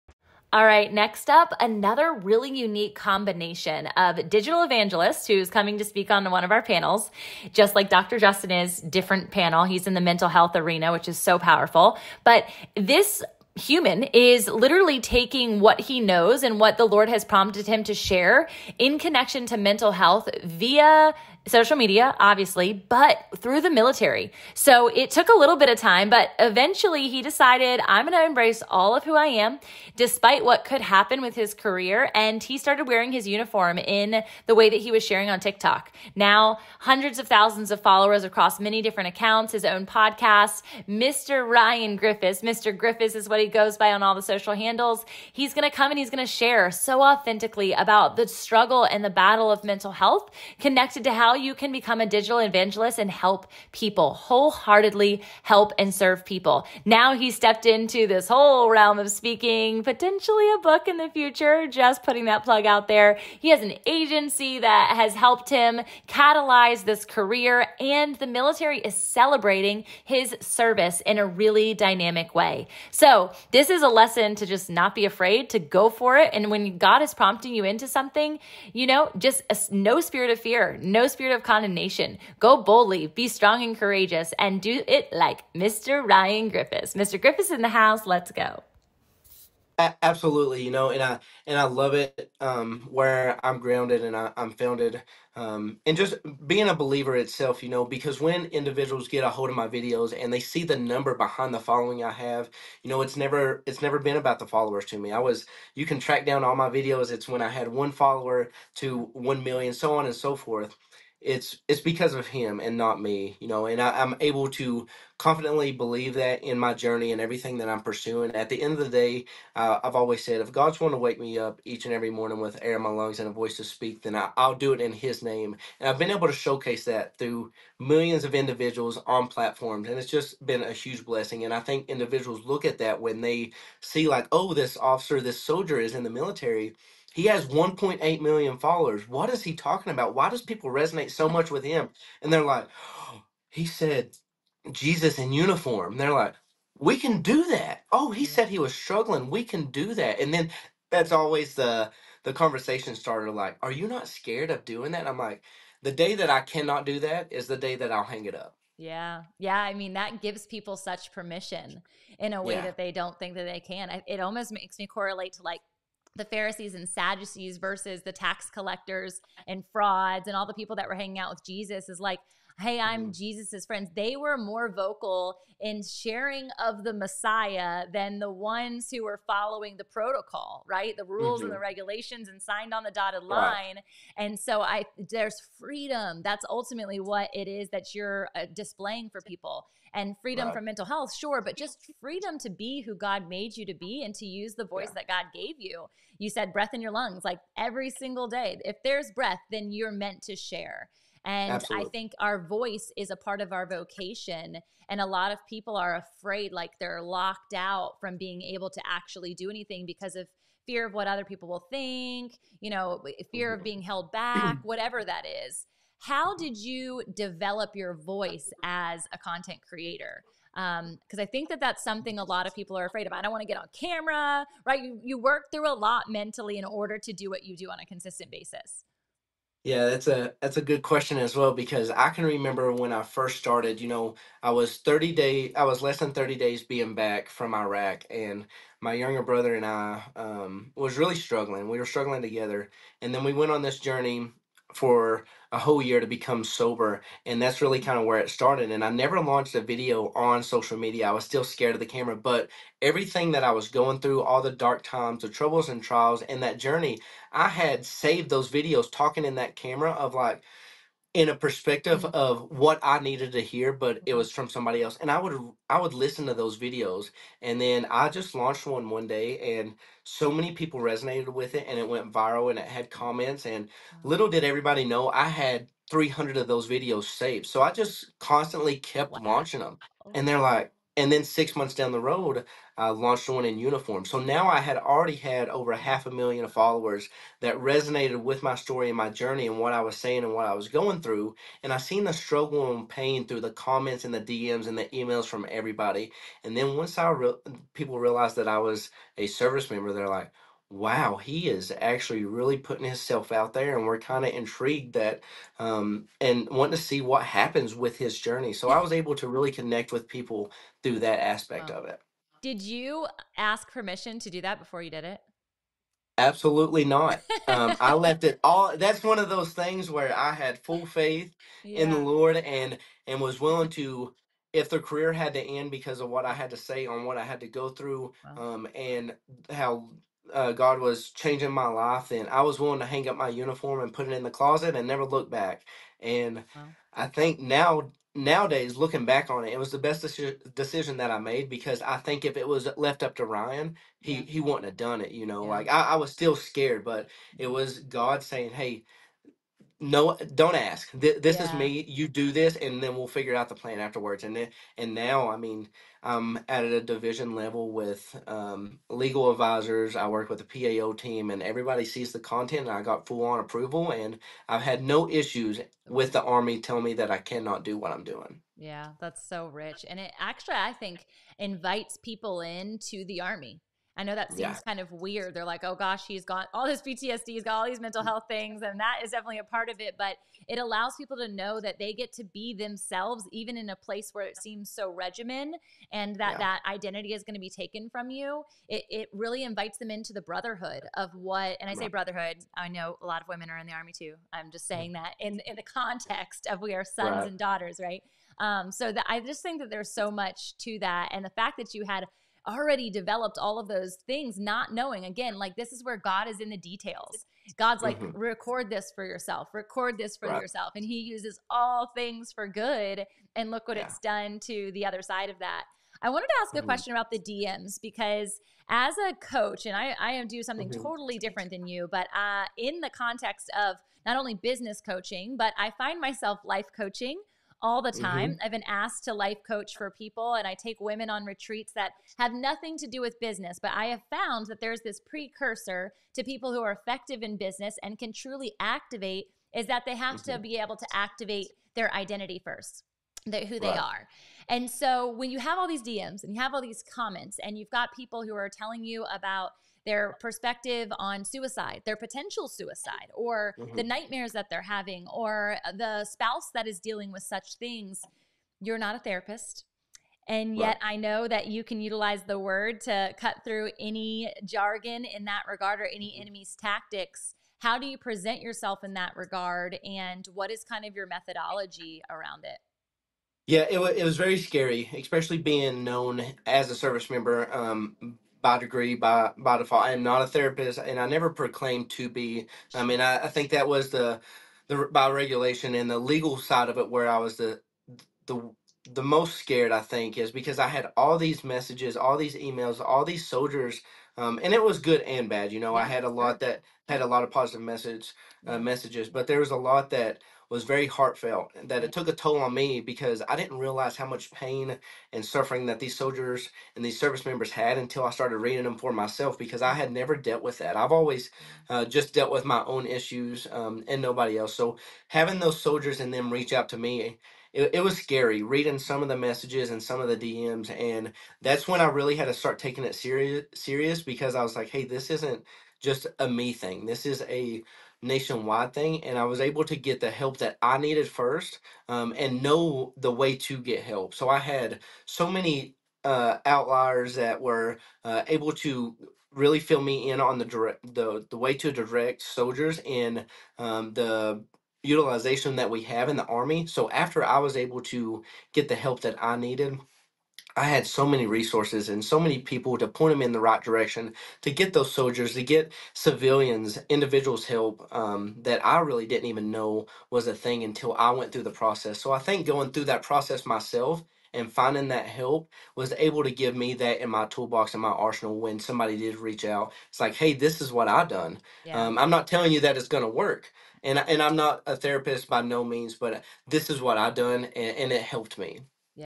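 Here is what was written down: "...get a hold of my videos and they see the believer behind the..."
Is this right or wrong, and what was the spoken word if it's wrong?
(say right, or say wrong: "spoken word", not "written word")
wrong: "number", not "believer".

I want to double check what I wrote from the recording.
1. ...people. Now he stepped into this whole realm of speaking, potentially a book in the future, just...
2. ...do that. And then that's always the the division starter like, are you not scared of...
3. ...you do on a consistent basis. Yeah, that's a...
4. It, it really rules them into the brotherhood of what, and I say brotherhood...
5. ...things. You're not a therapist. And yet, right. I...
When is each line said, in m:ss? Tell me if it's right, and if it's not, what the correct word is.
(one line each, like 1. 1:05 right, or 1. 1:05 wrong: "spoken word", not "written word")
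1. 0:56 right
2. 2:29 wrong: "conversation", not "division"
3. 3:47 right
4. 6:28 wrong: "invites", not "rules"
5. 7:37 right.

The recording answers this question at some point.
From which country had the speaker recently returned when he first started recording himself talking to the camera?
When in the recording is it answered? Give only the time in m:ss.
3:57.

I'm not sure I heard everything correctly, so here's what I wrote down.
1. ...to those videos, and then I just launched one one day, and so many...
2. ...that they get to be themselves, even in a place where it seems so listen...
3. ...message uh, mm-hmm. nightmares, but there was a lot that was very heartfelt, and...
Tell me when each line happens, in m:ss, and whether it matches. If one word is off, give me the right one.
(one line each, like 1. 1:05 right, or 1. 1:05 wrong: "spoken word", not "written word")
1. 4:26 right
2. 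6:21 wrong: "regimen", not "listen"
3. 8:17 wrong: "messages", not "nightmares".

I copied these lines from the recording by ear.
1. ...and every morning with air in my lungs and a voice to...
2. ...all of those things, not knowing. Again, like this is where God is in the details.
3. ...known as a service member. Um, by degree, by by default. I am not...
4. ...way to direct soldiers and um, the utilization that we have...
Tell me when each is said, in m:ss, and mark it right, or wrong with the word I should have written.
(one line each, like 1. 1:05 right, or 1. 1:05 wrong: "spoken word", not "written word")
1. 2:01 right
2. 6:43 right
3. 7:55 right
4. 9:01 right.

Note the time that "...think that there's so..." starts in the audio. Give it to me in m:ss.
6:39.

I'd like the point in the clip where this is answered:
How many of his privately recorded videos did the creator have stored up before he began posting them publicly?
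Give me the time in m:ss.
4:35.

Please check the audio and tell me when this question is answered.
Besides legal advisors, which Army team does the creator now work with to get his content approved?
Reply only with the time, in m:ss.
6:00.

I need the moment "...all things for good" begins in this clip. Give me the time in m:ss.
6:51.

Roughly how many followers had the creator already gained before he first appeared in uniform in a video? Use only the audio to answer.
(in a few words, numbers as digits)
Half a million.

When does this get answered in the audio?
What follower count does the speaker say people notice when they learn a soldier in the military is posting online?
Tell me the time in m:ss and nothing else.
2:17.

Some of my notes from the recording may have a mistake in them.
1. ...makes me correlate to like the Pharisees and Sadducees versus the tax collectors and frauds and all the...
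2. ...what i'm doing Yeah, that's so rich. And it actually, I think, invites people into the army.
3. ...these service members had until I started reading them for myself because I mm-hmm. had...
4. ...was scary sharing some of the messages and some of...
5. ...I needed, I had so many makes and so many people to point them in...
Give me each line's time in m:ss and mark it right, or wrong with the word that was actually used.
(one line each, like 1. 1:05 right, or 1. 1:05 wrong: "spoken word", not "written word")
1. 2:44 right
2. 6:07 right
3. 8:26 right
4. 8:37 wrong: "reading", not "sharing"
5. 9:09 wrong: "resources", not "makes".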